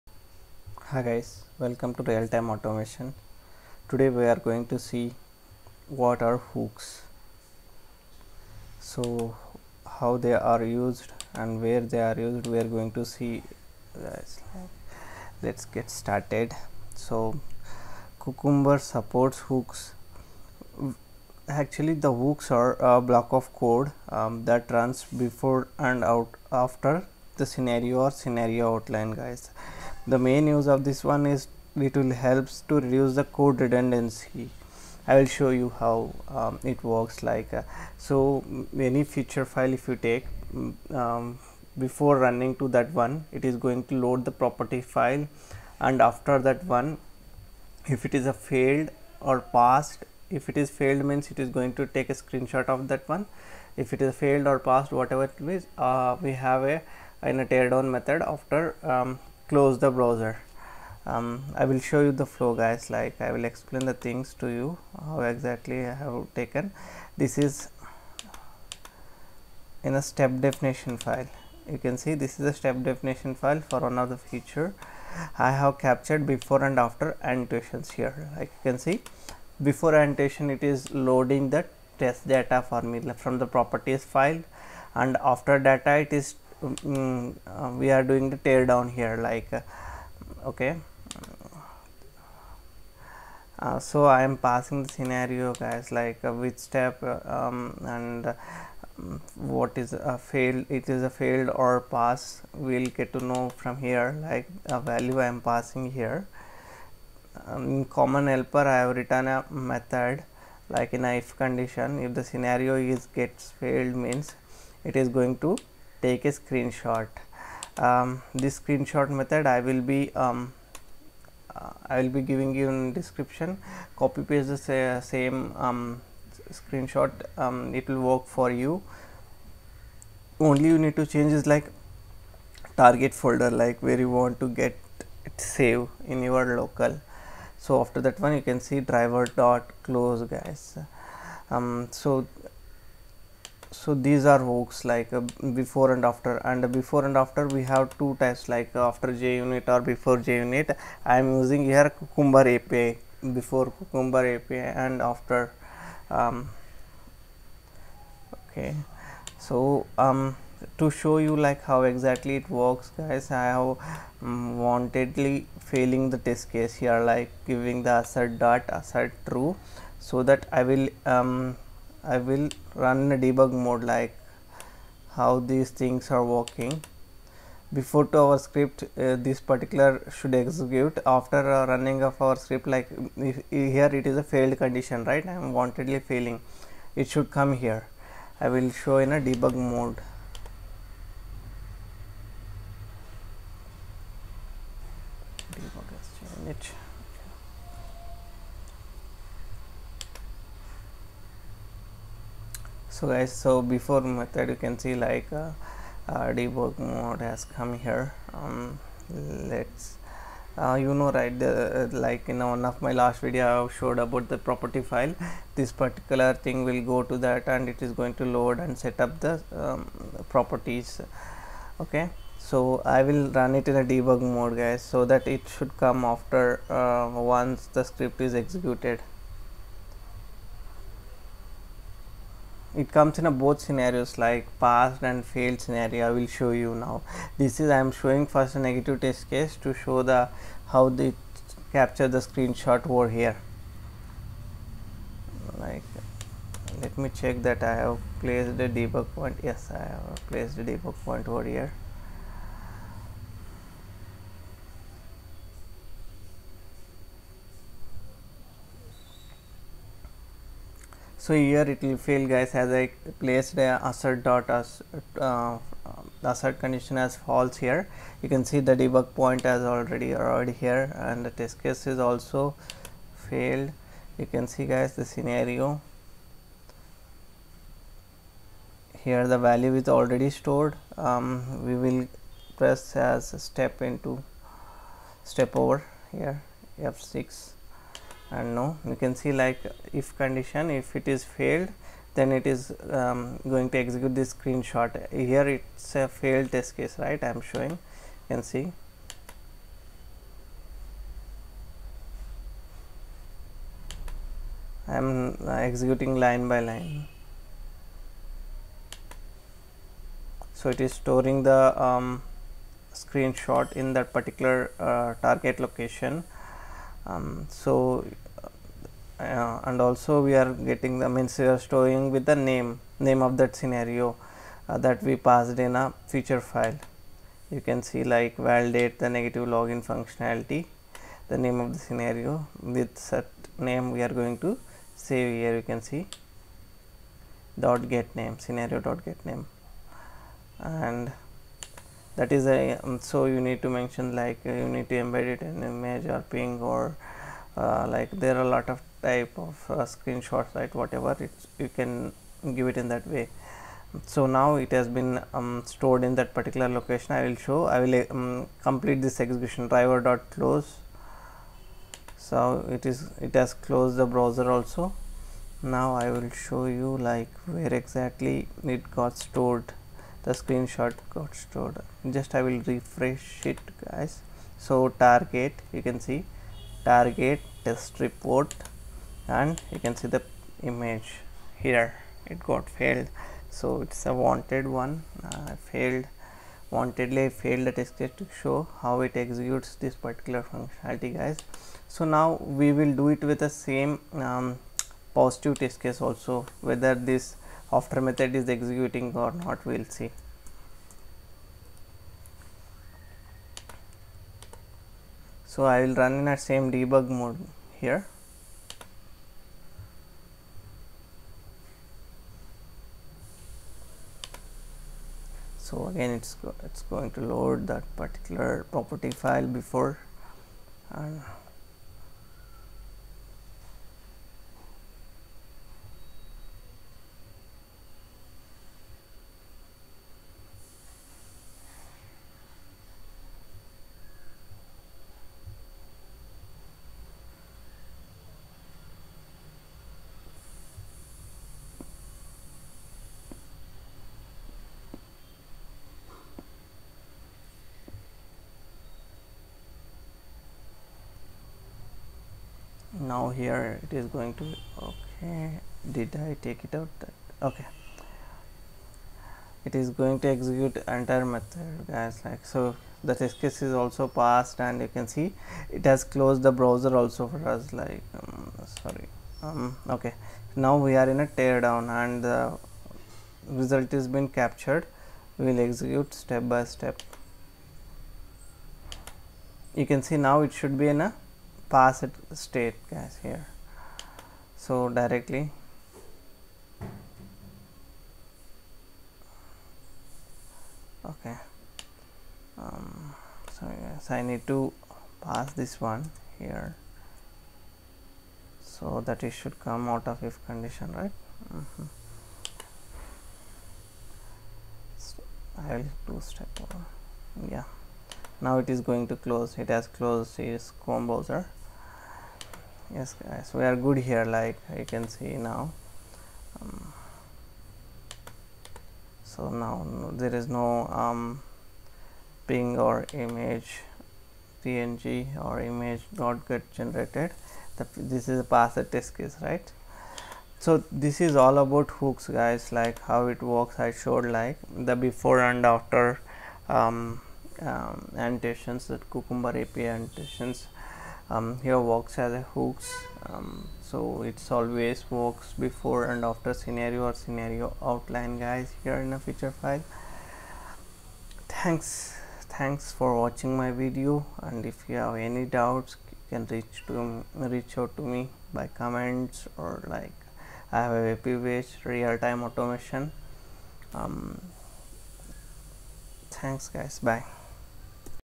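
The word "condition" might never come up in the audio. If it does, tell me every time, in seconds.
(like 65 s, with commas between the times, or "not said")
111 s, 184 s, 266 s, 290 s, 500 s.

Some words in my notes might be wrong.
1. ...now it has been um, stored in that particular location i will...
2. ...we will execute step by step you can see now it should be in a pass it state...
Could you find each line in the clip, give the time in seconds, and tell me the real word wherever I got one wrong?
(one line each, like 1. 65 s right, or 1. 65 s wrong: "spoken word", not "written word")
1. 354 s right
2. 475 s right.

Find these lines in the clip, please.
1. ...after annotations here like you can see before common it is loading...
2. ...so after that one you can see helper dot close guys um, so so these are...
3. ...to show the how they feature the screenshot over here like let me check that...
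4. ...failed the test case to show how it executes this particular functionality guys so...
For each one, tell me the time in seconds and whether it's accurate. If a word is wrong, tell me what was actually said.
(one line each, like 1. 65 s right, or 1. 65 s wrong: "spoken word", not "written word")
1. 76 s wrong: "annotation", not "common"
2. 137 s wrong: "driver", not "helper"
3. 239 s wrong: "capture", not "feature"
4. 387 s right.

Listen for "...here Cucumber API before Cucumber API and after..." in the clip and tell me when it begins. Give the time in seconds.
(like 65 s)
151 s.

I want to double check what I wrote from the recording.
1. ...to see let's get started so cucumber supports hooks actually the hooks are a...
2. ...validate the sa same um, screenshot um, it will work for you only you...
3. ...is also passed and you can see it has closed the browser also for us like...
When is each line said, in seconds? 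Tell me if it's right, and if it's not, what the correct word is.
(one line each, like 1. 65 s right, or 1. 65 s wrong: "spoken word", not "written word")
1. 12 s right
2. 124 s wrong: "paste", not "validate"
3. 463 s right.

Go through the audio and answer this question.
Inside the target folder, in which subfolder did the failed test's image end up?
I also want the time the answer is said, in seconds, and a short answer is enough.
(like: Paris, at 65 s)
test report, at 377 s.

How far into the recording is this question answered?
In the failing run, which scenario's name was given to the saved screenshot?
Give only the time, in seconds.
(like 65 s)
328 s.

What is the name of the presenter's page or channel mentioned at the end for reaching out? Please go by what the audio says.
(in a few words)
Real-time automation.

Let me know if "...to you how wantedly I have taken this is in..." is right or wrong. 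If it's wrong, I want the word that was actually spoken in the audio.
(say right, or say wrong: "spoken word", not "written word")
wrong: "exactly", not "wantedly".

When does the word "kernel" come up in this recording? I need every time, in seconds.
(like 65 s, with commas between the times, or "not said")
not said.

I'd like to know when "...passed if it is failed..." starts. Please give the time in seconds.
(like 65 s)
49 s.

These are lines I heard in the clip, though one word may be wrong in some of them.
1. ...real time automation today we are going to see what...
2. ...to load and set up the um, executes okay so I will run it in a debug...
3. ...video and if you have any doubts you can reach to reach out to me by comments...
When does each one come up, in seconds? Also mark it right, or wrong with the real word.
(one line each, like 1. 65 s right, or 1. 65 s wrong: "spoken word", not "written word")
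1. 2 s right
2. 218 s wrong: "properties", not "executes"
3. 553 s right.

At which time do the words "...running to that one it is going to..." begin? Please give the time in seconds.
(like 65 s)
42 s.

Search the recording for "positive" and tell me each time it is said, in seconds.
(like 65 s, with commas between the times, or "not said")
395 s.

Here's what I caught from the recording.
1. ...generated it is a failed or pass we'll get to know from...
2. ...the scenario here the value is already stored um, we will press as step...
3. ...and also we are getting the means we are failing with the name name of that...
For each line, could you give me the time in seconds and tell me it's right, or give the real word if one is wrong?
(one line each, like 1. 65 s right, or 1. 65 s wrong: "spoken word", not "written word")
1. 100 s wrong: "failed", not "generated"
2. 274 s right
3. 319 s wrong: "storing", not "failing".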